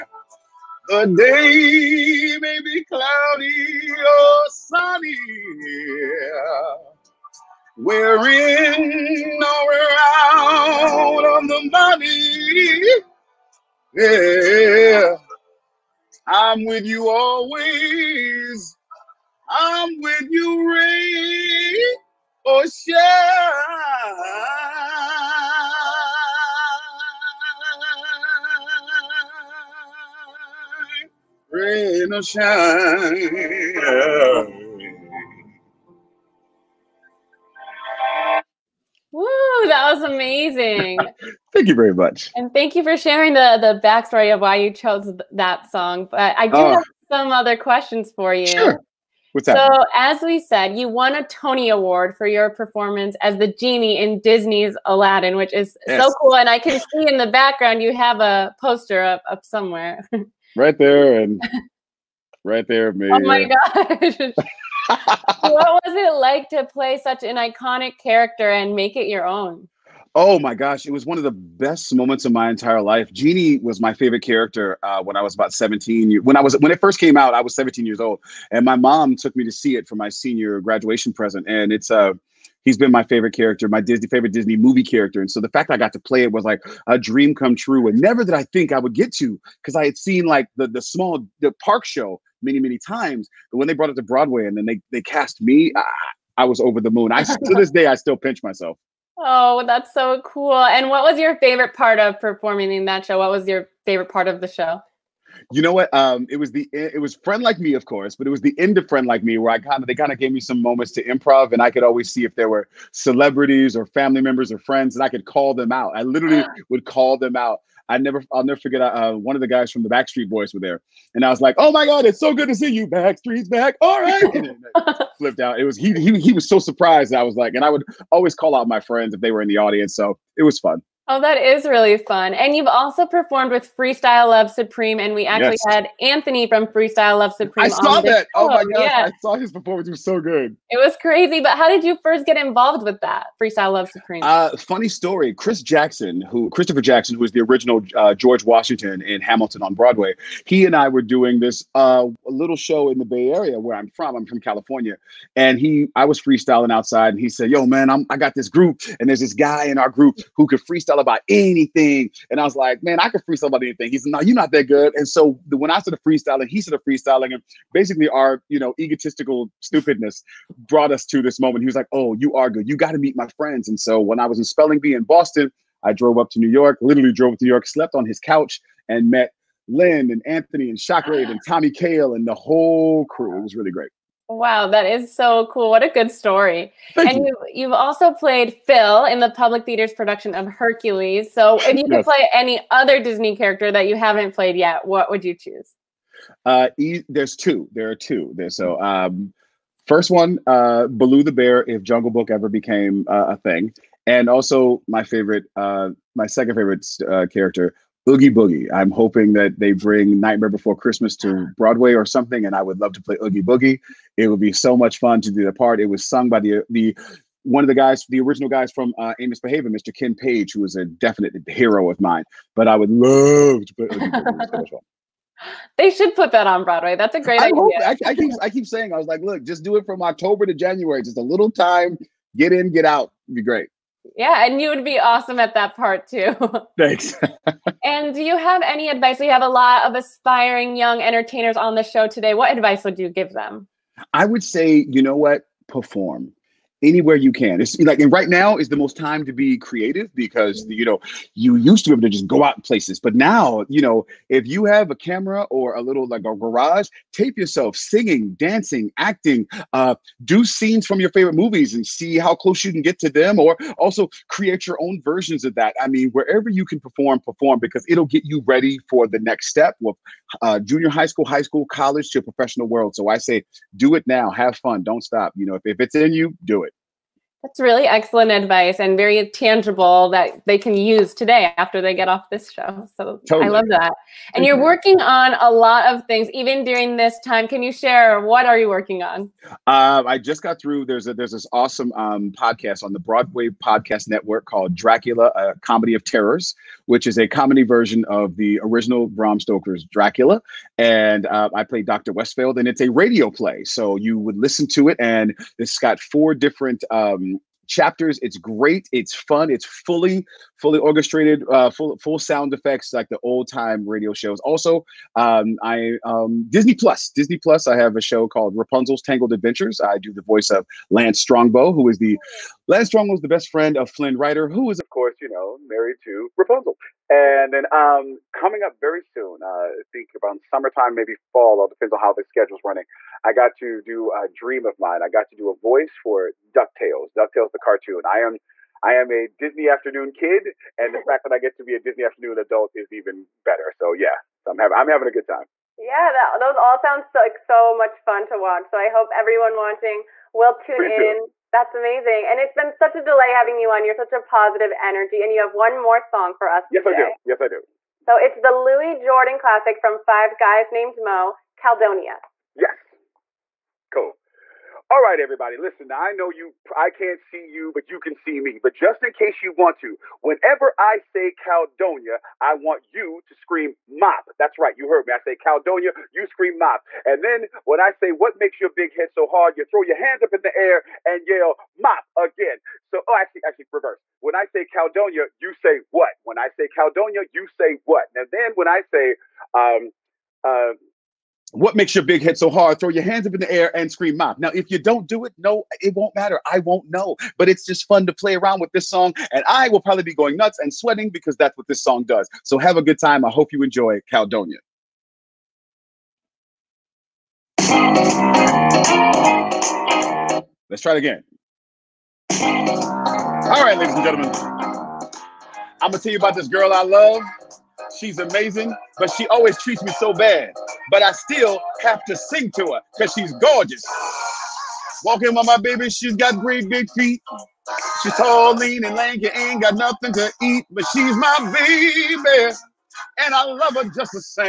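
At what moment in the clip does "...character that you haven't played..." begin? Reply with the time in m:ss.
3:13.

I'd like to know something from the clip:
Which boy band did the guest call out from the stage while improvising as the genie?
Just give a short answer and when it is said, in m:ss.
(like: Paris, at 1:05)
Backstreet Boys, at 1:59.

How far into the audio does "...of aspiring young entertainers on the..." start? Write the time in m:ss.
3:59.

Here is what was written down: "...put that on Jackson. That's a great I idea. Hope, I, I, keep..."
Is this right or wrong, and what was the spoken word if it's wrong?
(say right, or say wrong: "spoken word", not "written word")
wrong: "Broadway", not "Jackson".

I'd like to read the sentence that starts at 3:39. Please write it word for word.
Ken Page, who was a definite hero of mine.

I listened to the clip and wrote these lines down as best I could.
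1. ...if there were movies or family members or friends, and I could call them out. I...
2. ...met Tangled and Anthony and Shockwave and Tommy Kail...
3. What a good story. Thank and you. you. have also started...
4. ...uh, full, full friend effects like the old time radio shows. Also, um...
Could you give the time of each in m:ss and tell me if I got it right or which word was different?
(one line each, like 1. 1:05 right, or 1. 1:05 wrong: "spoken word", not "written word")
1. 1:52 wrong: "celebrities", not "movies"
2. 2:59 wrong: "Lynn", not "Tangled"
3. 3:05 wrong: "played", not "started"
4. 5:11 wrong: "sound", not "friend".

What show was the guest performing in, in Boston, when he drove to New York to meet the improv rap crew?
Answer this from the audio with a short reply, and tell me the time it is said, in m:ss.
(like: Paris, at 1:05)
Spelling Bee, at 2:54.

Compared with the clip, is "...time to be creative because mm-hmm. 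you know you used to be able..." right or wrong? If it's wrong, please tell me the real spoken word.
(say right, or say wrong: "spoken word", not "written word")
right.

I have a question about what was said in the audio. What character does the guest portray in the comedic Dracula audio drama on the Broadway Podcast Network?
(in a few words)
Dr. Westfield.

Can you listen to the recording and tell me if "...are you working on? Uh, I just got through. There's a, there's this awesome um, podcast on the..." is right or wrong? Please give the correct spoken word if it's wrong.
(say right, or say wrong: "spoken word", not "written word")
right.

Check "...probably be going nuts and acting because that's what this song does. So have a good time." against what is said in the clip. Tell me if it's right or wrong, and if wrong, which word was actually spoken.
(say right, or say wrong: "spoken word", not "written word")
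wrong: "sweating", not "acting".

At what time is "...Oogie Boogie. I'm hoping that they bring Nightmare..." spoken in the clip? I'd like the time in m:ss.
3:28.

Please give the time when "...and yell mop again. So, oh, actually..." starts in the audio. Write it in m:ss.
6:21.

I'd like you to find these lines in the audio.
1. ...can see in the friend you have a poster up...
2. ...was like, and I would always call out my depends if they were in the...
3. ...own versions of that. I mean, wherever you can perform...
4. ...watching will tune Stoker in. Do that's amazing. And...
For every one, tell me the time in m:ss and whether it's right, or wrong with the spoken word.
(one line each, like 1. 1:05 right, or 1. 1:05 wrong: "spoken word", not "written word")
1. 0:56 wrong: "background", not "friend"
2. 2:07 wrong: "friends", not "depends"
3. 4:24 right
4. 5:49 wrong: "Please", not "Stoker".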